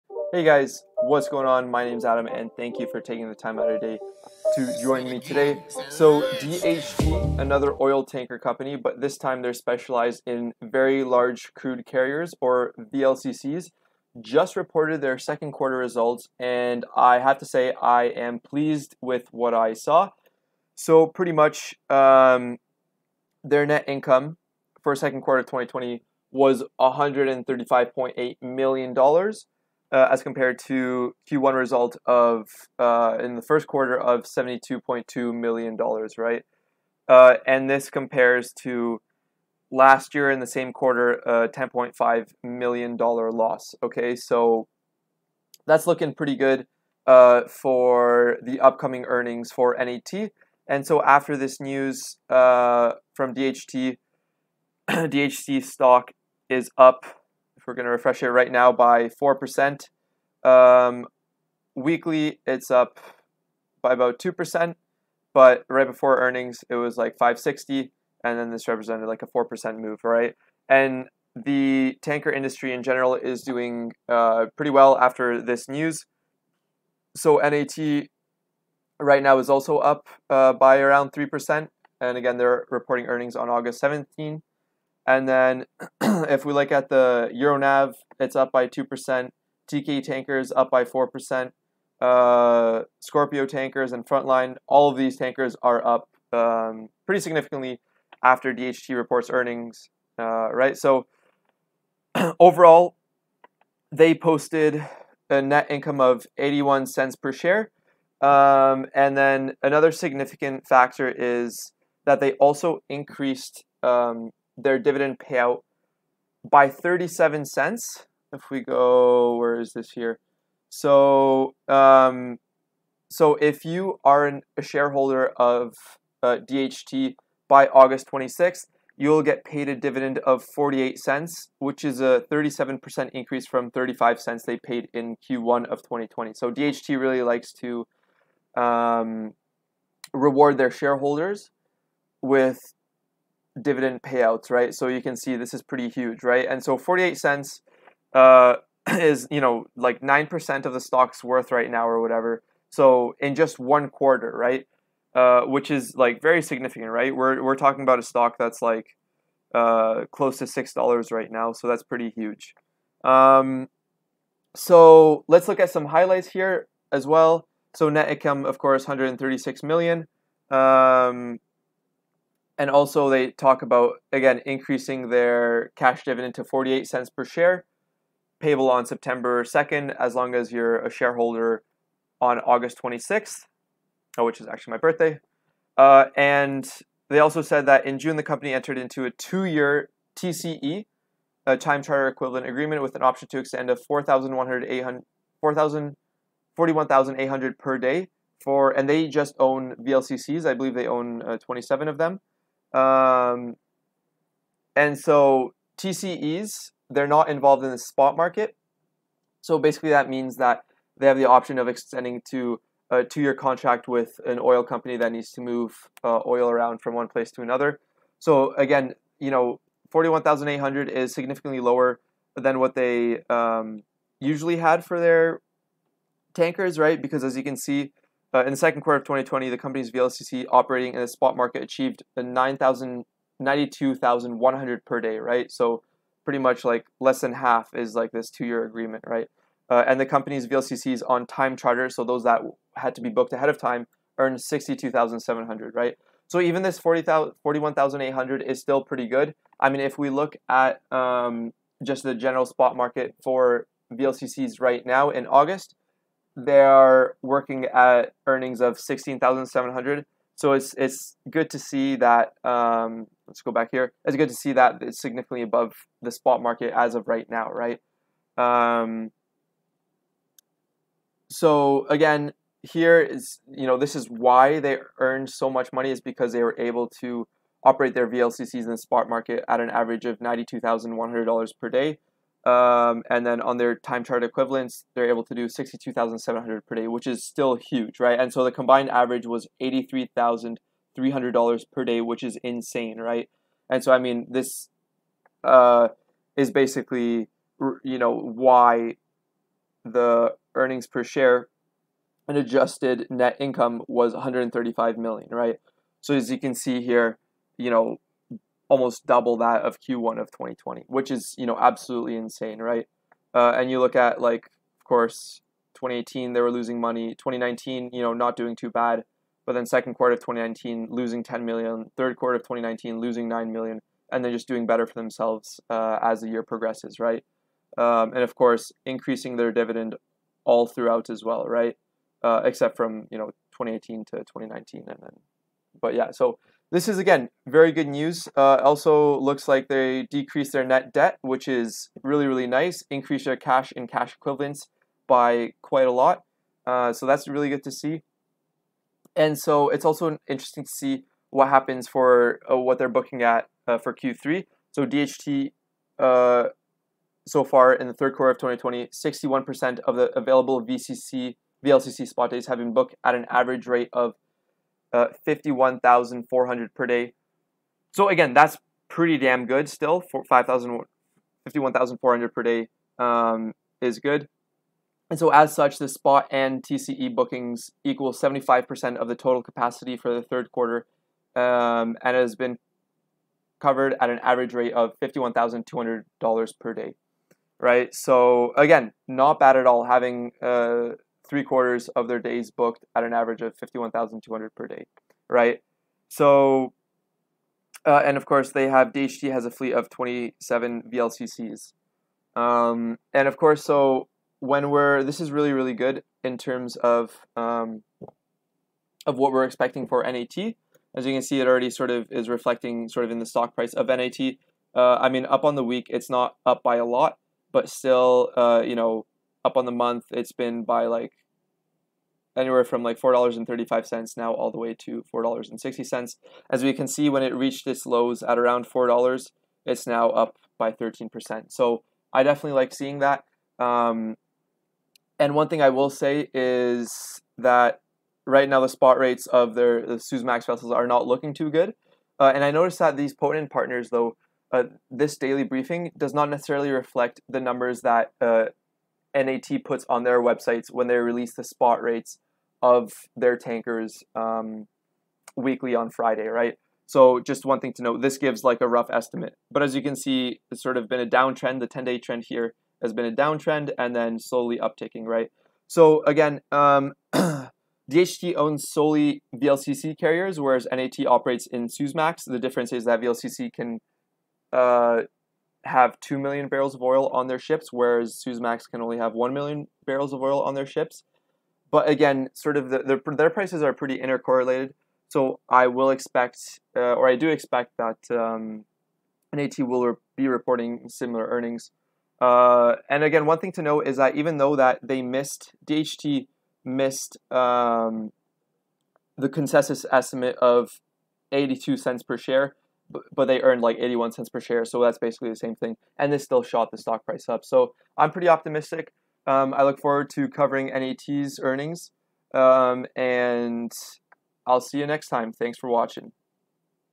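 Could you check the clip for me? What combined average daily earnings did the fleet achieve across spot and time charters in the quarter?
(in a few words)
$83,300 per day.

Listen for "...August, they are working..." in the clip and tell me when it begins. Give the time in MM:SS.
04:15.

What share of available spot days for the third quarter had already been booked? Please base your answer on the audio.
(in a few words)
61%.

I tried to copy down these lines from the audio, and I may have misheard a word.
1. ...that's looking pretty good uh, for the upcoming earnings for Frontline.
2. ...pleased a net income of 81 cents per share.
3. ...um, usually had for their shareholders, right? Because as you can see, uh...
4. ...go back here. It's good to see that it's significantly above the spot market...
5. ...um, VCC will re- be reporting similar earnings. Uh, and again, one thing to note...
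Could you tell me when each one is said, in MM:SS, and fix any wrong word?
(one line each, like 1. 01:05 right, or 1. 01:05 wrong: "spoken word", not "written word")
1. 00:45 wrong: "NET", not "Frontline"
2. 01:44 wrong: "posted", not "pleased"
3. 03:43 wrong: "tankers", not "shareholders"
4. 04:23 right
5. 08:08 wrong: "NAT", not "VCC".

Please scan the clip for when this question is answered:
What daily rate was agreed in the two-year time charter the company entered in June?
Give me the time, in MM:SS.
03:16.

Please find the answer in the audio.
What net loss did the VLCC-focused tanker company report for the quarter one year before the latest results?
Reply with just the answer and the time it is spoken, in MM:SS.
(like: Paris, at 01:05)
$10.5 million, at 00:41.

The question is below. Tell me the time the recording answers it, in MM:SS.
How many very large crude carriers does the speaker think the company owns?
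03:21.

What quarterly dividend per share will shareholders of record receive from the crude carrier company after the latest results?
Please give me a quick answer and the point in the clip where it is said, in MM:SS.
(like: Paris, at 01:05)
48 cents, at 02:09.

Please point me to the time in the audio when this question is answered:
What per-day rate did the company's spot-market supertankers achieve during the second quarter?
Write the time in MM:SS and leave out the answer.
03:52.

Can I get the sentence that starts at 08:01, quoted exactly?
But again, sort of the, their prices are pretty intercorrelated.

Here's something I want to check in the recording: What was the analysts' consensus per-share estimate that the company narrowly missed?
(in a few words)
82 cents.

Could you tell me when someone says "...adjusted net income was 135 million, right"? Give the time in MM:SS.
05:02.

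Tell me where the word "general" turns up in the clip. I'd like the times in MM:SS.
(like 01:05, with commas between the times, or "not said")
01:12, 04:12.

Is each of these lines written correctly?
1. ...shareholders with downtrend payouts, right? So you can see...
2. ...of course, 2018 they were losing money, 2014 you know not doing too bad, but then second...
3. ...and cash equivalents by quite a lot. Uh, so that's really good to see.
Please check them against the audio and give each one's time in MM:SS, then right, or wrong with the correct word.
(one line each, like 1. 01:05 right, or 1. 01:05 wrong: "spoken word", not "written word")
1. 02:20 wrong: "dividend", not "downtrend"
2. 05:14 wrong: "2019", not "2014"
3. 05:43 right.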